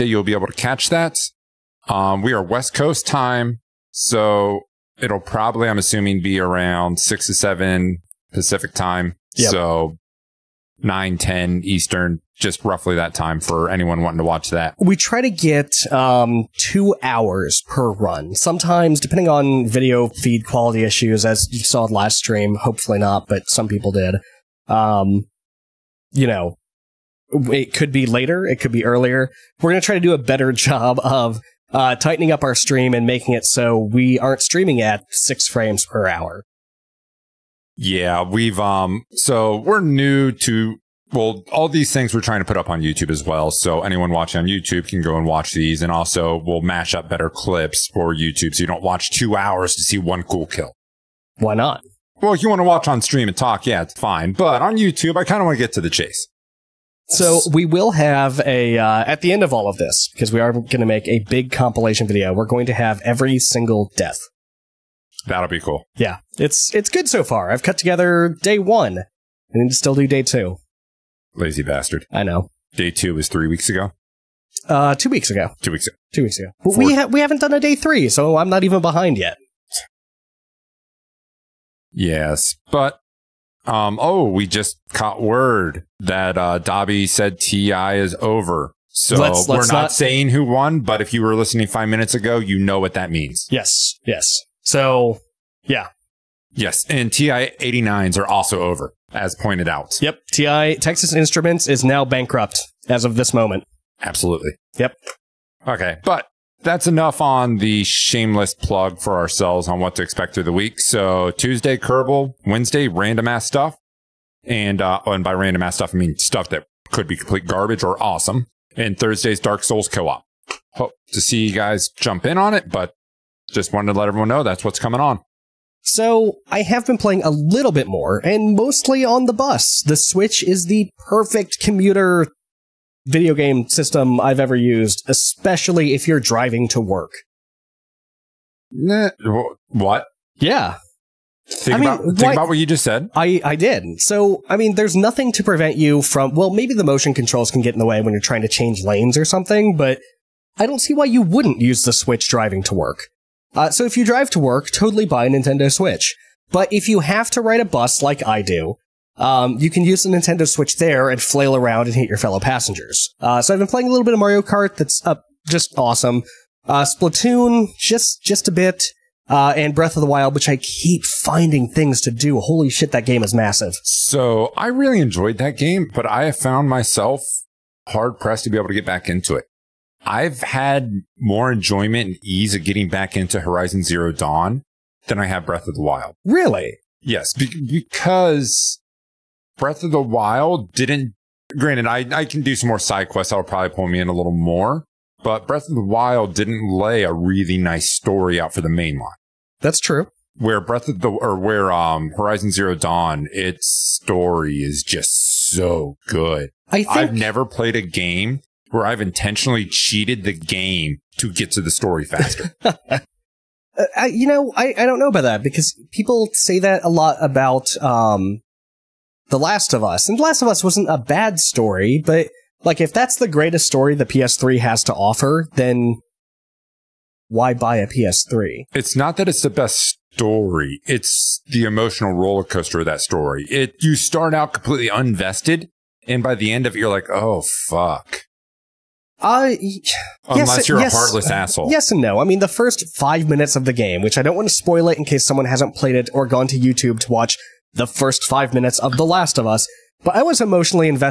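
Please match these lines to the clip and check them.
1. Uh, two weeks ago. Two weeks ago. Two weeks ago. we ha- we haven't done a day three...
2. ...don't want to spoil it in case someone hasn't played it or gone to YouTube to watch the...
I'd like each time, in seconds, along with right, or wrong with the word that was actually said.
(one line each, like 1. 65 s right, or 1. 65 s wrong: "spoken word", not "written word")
1. 74 s right
2. 244 s right.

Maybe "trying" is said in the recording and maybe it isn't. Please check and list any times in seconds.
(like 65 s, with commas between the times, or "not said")
42 s, 148 s.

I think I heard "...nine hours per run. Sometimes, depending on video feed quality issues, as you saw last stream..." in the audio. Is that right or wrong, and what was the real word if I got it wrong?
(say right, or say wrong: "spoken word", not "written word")
wrong: "two", not "nine".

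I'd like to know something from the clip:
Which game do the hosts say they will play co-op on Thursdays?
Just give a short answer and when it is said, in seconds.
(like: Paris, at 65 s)
Dark Souls, at 119 s.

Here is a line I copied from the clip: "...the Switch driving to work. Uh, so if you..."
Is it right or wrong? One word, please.
right.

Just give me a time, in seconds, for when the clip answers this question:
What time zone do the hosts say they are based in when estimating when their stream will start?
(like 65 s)
2 s.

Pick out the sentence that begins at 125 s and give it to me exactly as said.
So I have been playing a little bit more and mostly on the bus.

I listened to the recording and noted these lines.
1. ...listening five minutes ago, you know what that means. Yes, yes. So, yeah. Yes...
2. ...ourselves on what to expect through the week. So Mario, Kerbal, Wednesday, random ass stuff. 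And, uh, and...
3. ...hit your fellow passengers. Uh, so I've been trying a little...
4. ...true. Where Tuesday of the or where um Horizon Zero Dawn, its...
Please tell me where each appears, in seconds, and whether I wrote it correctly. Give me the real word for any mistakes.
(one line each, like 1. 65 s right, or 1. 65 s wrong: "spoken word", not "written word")
1. 91 s right
2. 109 s wrong: "Tuesday", not "Mario"
3. 161 s wrong: "playing", not "trying"
4. 199 s wrong: "Breath", not "Tuesday".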